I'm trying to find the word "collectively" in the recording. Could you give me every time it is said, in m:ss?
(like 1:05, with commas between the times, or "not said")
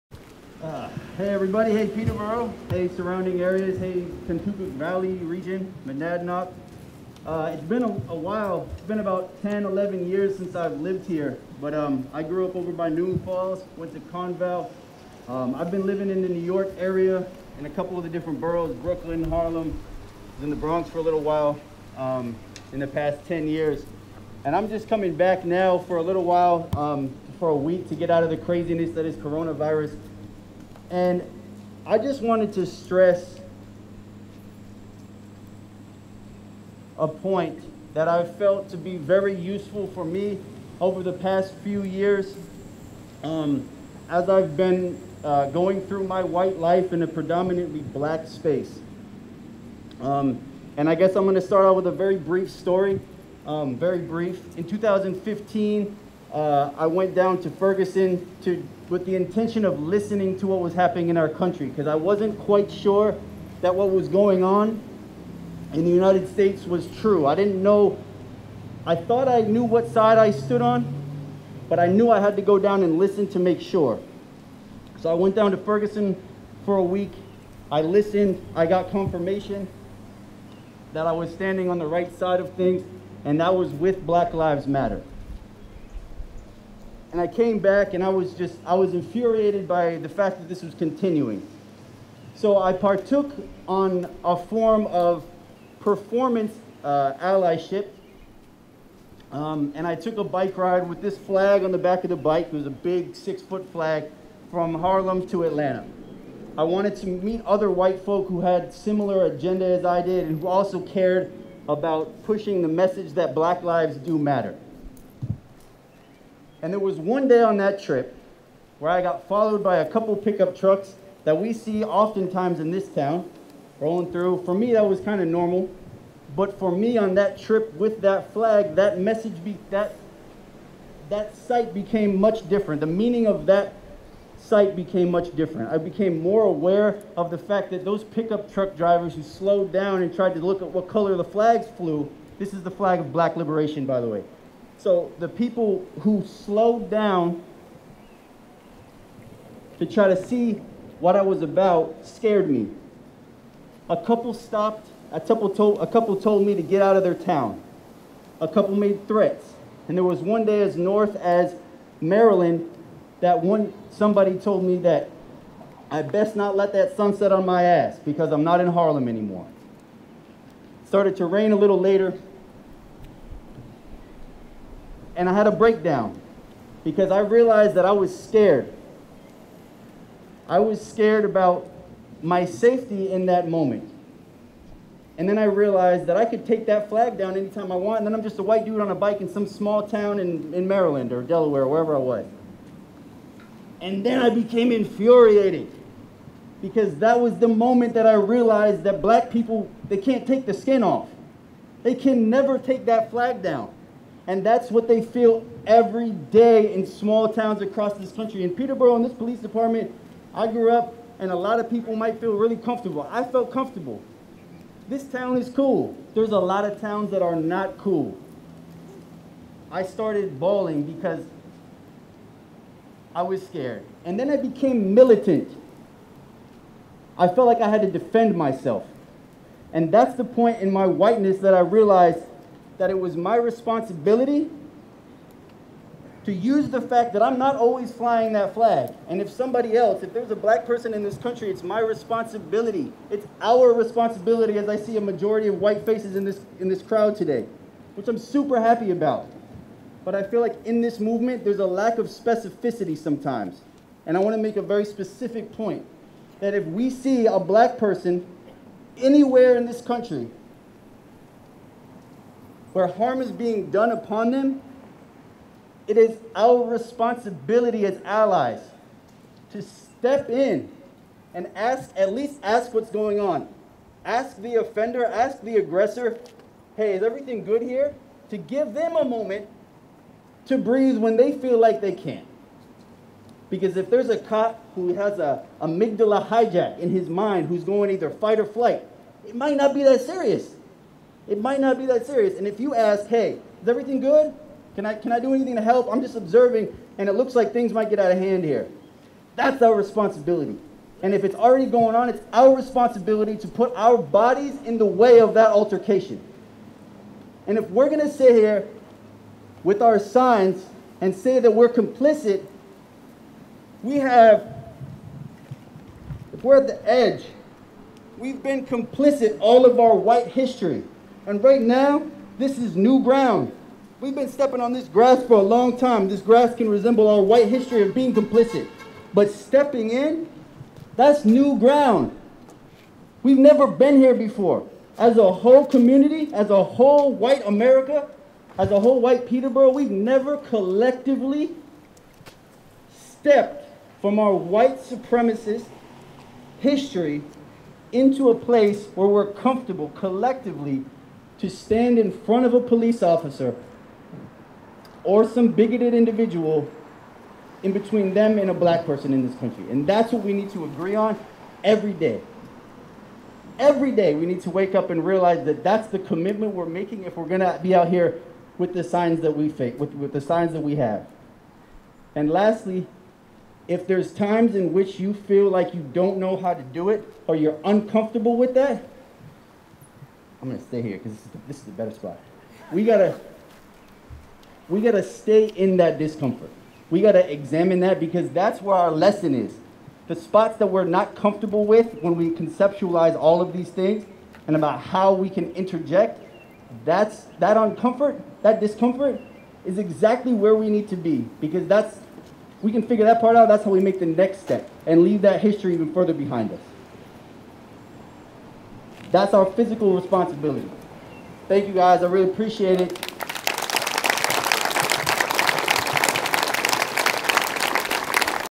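5:40, 5:49.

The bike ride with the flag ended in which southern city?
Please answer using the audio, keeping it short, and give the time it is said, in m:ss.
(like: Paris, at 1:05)
Atlanta, at 1:45.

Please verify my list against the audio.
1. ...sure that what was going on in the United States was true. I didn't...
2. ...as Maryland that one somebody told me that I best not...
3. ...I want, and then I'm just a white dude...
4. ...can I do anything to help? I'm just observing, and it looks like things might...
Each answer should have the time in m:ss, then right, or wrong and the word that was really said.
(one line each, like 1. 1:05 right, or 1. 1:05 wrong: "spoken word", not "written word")
1. 1:02 right
2. 2:41 right
3. 3:07 right
4. 4:54 right.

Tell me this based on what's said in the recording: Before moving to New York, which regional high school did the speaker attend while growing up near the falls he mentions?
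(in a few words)
Conval.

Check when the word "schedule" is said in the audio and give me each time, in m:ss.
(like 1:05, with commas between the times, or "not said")
not said.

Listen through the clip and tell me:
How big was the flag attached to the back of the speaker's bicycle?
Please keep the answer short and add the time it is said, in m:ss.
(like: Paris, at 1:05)
six foot, at 1:43.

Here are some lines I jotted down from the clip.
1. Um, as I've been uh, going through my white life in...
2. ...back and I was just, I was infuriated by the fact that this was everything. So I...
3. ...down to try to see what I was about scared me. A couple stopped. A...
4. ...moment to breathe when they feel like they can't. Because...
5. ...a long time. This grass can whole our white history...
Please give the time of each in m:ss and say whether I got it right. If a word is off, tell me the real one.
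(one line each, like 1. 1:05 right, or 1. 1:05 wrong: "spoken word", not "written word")
1. 0:43 right
2. 1:27 wrong: "continuing", not "everything"
3. 2:26 right
4. 4:39 right
5. 5:25 wrong: "resemble", not "whole".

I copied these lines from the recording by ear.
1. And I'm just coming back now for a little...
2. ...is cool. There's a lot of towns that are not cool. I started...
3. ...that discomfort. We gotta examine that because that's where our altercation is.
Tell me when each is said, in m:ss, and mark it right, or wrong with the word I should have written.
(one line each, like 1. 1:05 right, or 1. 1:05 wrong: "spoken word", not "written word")
1. 0:24 right
2. 3:35 right
3. 6:25 wrong: "lesson", not "altercation".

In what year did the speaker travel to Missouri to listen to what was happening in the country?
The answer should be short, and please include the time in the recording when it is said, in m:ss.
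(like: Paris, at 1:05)
2015, at 0:54.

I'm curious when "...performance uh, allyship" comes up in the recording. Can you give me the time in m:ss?
1:35.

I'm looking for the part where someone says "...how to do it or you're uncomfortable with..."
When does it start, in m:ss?
6:16.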